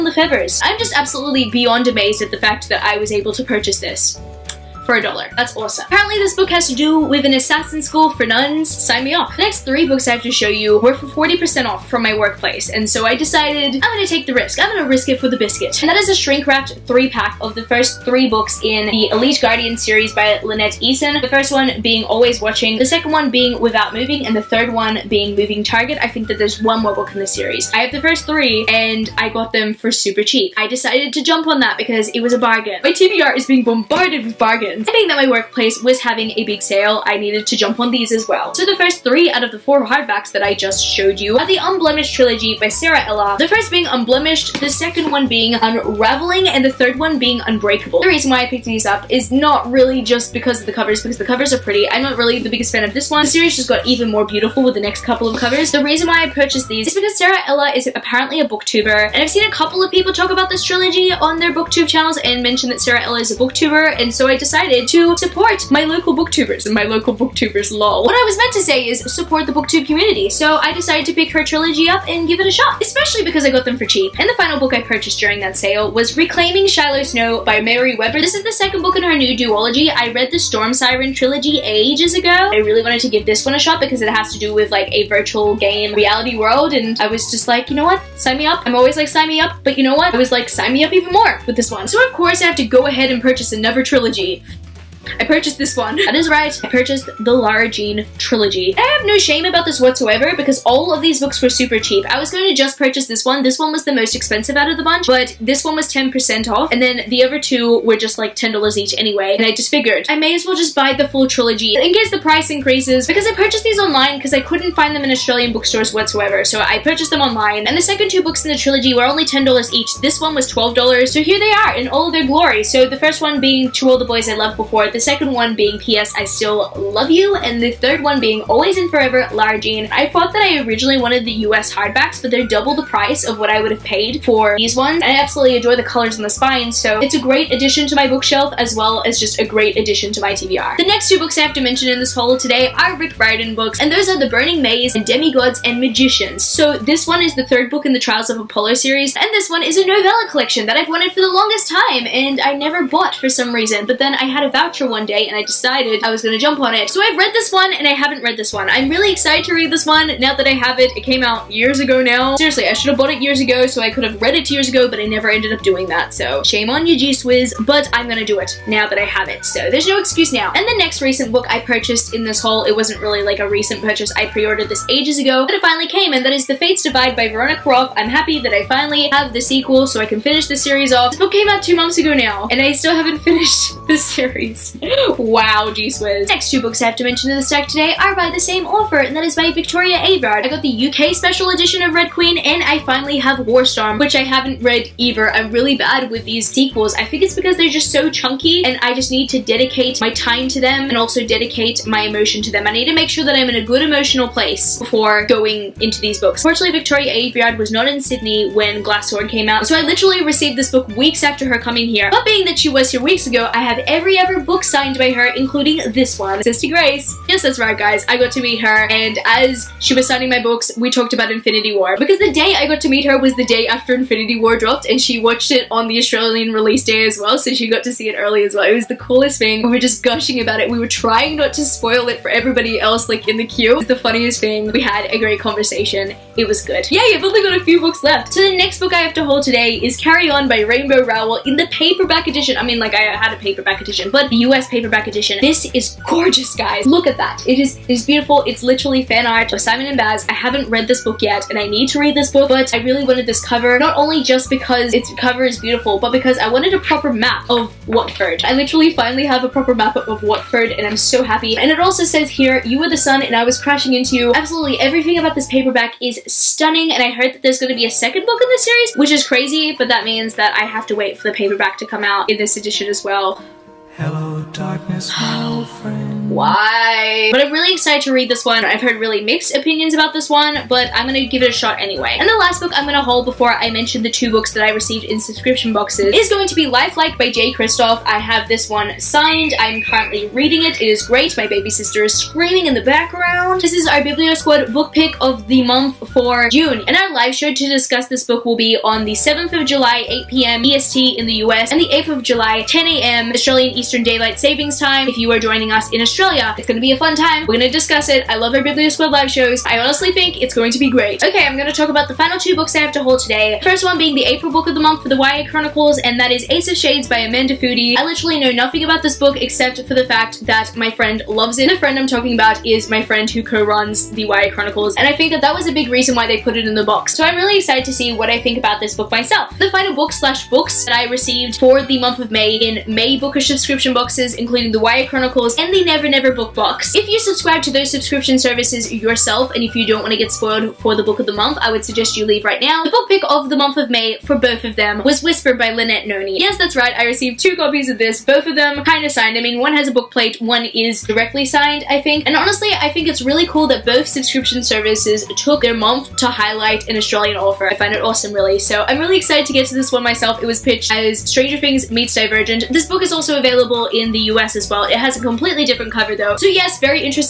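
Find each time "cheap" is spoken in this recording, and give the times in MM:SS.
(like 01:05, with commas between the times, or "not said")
00:30, 01:13, 01:41.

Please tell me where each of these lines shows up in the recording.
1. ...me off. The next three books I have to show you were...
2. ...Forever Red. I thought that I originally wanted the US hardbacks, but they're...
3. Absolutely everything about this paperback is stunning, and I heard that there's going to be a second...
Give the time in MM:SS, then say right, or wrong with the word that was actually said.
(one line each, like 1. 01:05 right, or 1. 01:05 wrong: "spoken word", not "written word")
1. 00:09 right
2. 02:08 wrong: "Jean", not "Red"
3. 04:24 right.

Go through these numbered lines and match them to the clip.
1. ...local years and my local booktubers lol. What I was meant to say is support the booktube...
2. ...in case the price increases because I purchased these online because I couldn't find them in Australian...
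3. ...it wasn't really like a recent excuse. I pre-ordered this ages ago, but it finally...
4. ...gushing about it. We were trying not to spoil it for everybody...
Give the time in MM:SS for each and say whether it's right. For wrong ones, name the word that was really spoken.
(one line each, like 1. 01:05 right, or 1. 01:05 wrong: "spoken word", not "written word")
1. 01:05 wrong: "booktubers", not "years"
2. 01:51 right
3. 02:52 wrong: "purchase", not "excuse"
4. 03:50 right.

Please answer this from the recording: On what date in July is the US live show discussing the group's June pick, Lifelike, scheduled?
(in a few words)
July 7.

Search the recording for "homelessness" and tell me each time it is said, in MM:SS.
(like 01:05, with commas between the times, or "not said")
not said.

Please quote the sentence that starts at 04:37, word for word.
But I'm really excited to read this one.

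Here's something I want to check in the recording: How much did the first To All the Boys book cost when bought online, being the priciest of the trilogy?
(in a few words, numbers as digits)
$12.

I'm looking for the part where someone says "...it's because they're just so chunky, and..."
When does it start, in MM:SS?
03:17.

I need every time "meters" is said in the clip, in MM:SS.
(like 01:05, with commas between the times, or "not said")
not said.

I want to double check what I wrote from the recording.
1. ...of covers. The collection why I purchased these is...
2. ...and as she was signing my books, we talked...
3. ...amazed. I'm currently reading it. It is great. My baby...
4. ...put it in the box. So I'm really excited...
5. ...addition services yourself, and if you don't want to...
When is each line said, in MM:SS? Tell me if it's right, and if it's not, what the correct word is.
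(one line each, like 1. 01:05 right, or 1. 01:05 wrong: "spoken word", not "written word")
1. 00:55 wrong: "reason", not "collection"
2. 03:38 right
3. 04:49 wrong: "signed", not "amazed"
4. 05:26 right
5. 05:37 wrong: "subscription", not "addition".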